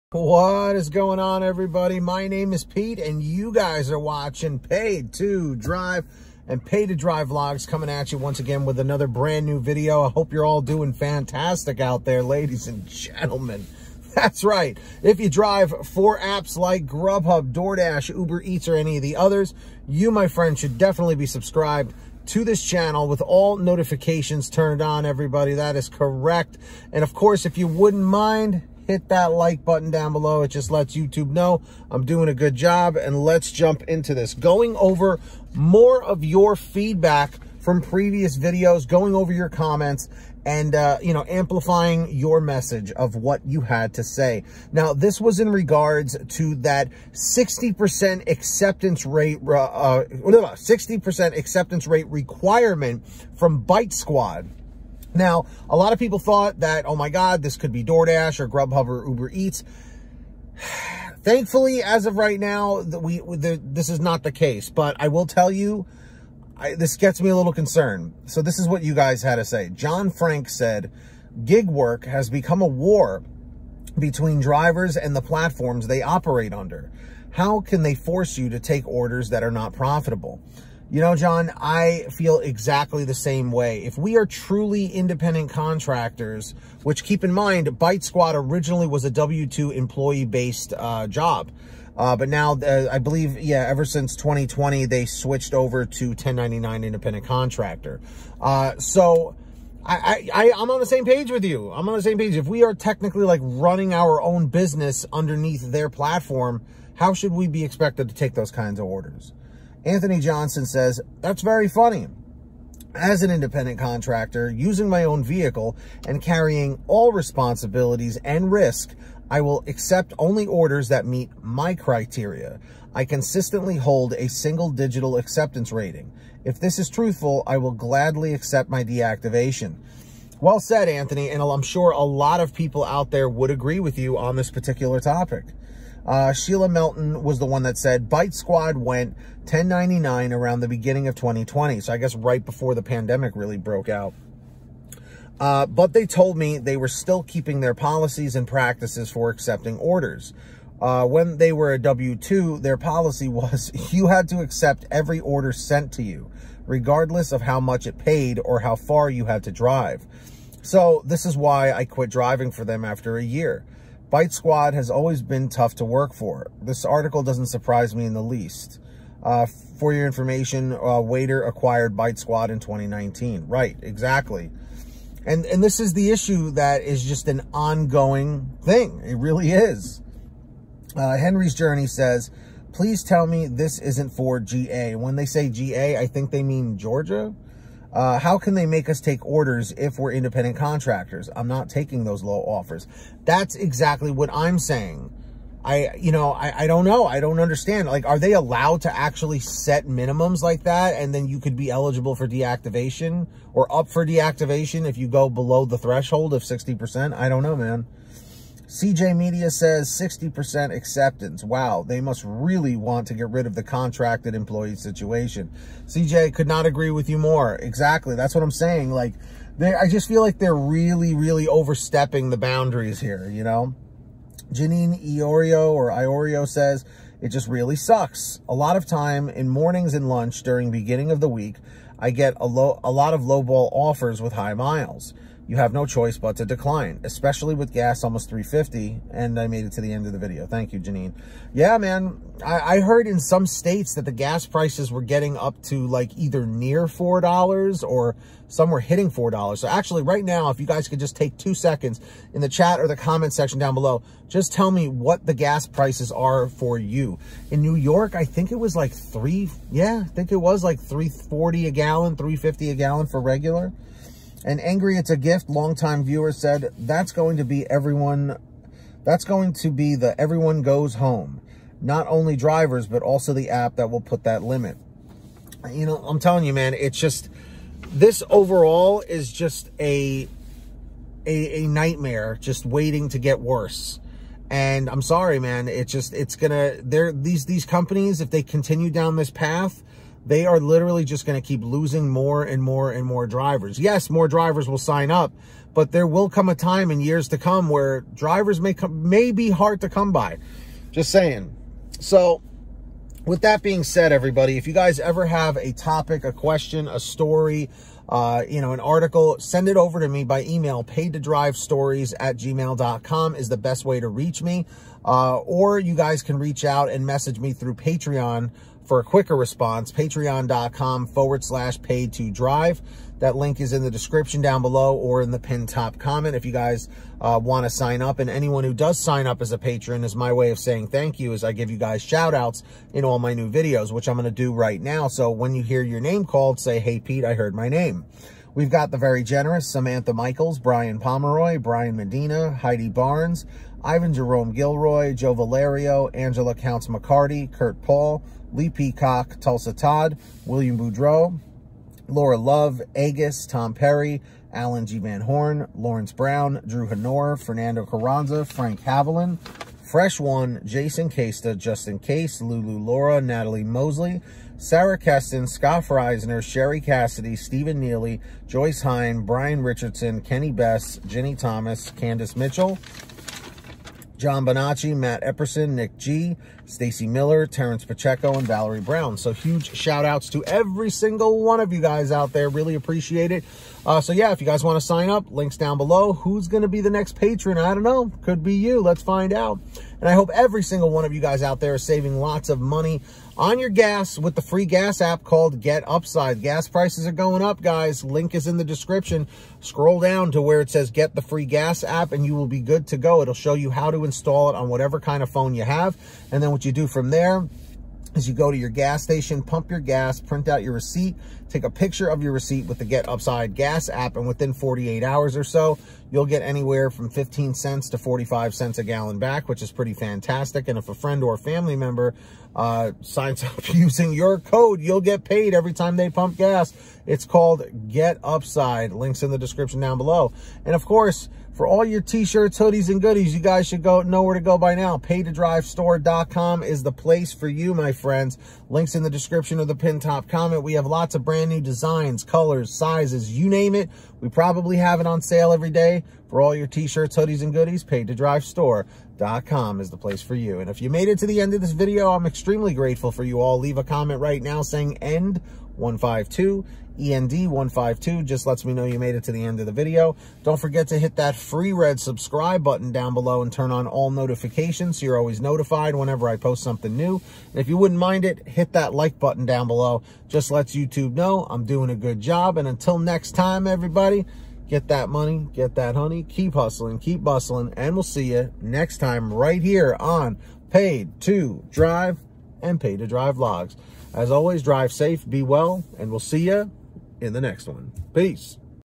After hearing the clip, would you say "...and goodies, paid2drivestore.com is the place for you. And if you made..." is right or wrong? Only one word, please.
right.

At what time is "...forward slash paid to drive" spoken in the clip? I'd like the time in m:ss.
5:21.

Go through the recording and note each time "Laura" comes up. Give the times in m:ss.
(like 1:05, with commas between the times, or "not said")
5:52, 6:02.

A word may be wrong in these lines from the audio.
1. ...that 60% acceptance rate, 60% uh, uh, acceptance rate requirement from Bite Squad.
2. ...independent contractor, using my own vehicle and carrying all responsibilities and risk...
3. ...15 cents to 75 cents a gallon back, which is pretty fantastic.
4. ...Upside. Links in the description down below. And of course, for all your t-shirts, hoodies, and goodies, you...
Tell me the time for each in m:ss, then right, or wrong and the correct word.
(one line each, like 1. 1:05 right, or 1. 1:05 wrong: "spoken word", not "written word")
1. 0:46 right
2. 1:53 right
3. 6:57 wrong: "45", not "75"
4. 7:08 right.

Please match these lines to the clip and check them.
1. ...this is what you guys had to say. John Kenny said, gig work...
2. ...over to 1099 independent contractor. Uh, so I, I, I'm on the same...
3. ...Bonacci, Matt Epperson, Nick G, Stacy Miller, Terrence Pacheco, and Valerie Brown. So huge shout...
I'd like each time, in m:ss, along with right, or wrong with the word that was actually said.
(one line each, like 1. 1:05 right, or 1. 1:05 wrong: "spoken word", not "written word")
1. 1:08 wrong: "Frank", not "Kenny"
2. 1:35 right
3. 6:14 right.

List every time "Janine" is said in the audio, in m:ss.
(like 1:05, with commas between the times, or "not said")
3:44, 4:00.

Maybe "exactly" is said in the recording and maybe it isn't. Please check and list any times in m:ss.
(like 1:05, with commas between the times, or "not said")
1:22, 2:53, 3:13, 3:37.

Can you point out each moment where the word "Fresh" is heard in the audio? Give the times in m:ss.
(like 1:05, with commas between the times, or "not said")
5:59.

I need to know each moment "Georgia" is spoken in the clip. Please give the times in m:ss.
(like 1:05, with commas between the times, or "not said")
3:06.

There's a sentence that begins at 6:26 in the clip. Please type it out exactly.
Who's going to be the next patron?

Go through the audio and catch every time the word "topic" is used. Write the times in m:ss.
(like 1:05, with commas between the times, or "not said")
2:14, 5:05.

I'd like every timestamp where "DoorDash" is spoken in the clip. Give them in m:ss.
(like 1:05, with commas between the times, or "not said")
0:17, 0:57.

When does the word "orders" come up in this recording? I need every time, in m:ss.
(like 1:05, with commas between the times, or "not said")
1:18, 1:48, 2:00, 2:29, 2:35, 3:09.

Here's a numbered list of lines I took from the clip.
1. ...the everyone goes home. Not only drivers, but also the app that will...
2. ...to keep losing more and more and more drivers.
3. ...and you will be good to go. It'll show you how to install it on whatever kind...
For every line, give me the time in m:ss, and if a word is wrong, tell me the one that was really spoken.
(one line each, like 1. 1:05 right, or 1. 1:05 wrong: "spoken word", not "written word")
1. 4:29 right
2. 4:51 right
3. 6:42 right.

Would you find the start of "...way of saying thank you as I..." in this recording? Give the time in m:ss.
5:30.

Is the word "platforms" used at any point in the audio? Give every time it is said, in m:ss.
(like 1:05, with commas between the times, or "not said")
1:15, 1:45.